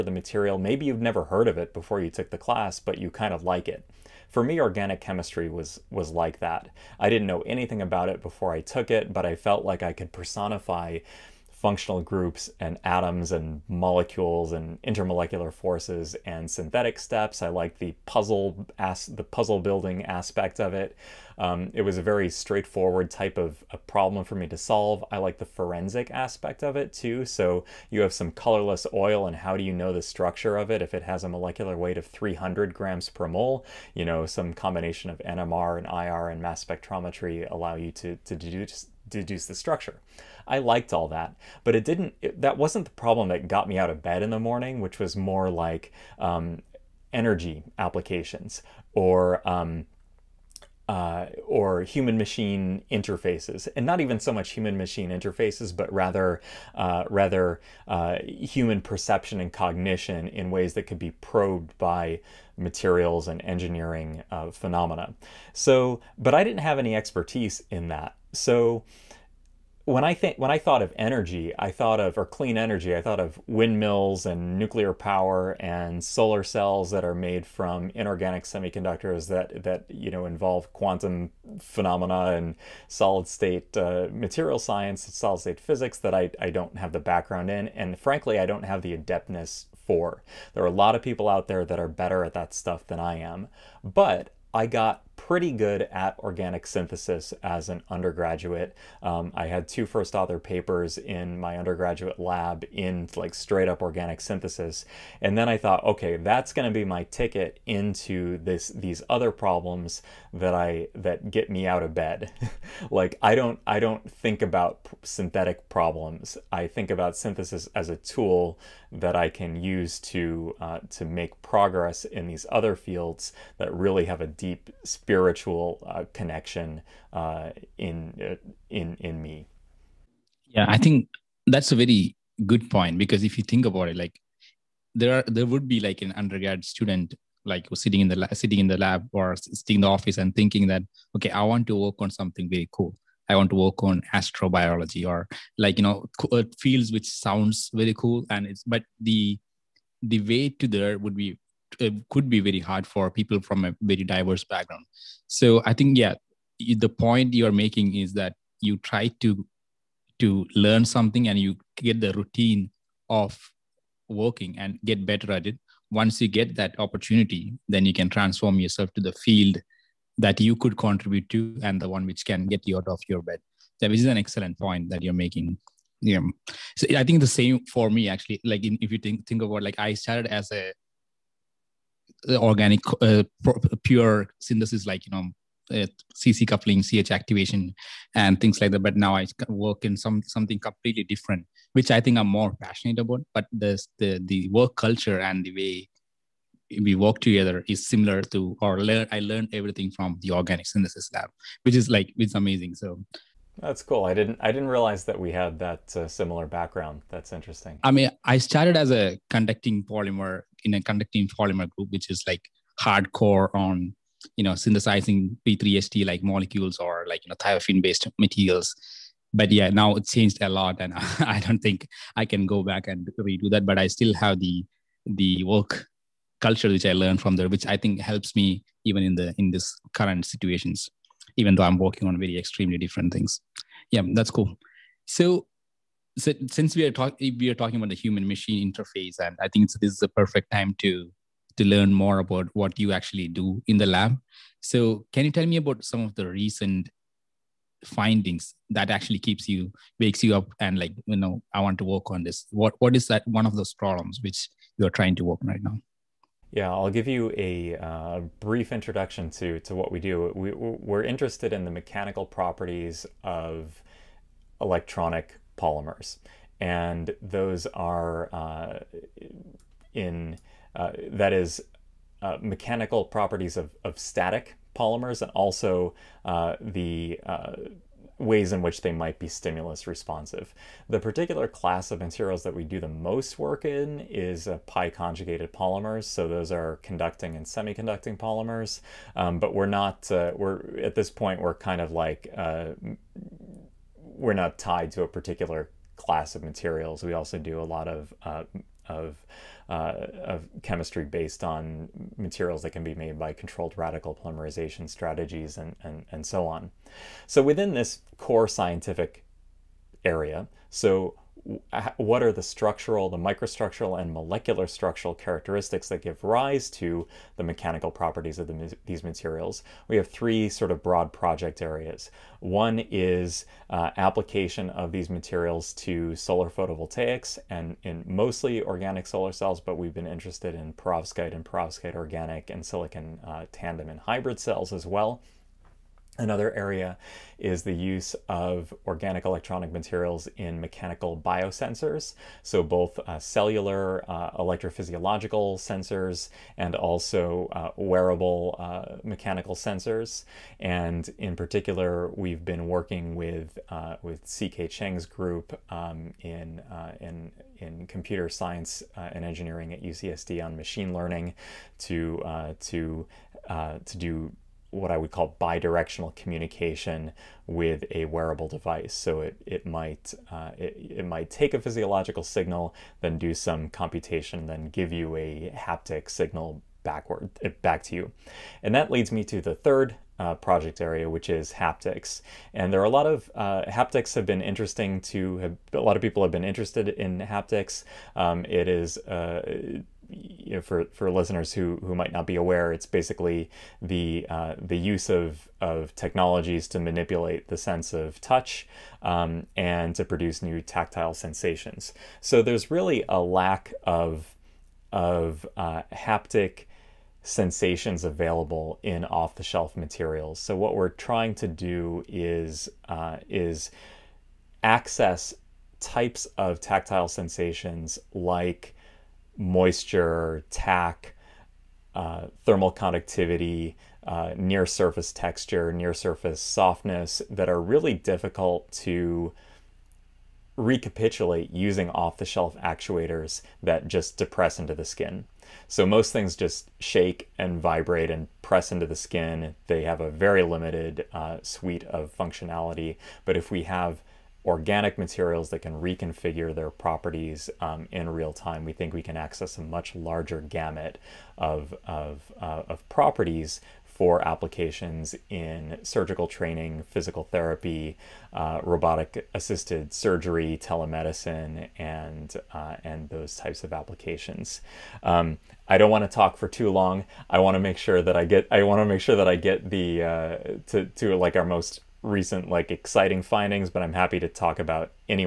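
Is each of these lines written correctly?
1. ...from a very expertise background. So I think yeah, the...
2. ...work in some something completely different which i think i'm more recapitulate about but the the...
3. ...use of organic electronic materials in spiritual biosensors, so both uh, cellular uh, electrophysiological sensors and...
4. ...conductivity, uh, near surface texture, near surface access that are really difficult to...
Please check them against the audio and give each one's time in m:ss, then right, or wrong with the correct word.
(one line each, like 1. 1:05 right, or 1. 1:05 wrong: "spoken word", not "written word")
1. 2:33 wrong: "diverse", not "expertise"
2. 3:09 wrong: "passionate", not "recapitulate"
3. 5:37 wrong: "mechanical", not "spiritual"
4. 7:02 wrong: "softness", not "access".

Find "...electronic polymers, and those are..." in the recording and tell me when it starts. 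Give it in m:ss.
4:24.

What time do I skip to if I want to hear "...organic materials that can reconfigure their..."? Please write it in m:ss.
7:24.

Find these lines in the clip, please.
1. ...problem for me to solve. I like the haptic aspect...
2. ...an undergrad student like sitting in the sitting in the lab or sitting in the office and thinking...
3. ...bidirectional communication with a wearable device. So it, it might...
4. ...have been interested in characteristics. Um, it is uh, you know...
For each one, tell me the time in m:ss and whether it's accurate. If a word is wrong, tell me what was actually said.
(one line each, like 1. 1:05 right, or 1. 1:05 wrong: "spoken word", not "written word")
1. 0:23 wrong: "forensic", not "haptic"
2. 2:16 right
3. 6:05 right
4. 6:26 wrong: "haptics", not "characteristics".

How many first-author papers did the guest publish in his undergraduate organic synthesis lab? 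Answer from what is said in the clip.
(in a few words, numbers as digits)
2.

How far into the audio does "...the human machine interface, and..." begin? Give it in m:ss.
3:57.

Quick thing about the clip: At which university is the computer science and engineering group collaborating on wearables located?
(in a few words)
UCSD.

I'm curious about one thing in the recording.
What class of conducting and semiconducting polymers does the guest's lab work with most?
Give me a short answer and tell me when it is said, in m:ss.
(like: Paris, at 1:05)
pi conjugated polymers, at 4:44.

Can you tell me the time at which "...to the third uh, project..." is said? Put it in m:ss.
6:19.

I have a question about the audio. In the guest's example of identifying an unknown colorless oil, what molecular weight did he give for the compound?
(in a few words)
300 grams per mole.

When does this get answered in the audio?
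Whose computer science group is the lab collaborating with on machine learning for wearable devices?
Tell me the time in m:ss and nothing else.
5:54.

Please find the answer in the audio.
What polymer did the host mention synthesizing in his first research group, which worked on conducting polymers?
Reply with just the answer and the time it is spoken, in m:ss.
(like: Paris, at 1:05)
P3HT, at 3:35.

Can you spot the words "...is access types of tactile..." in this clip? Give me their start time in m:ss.
6:53.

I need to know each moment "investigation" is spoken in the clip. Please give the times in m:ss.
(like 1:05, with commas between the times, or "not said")
not said.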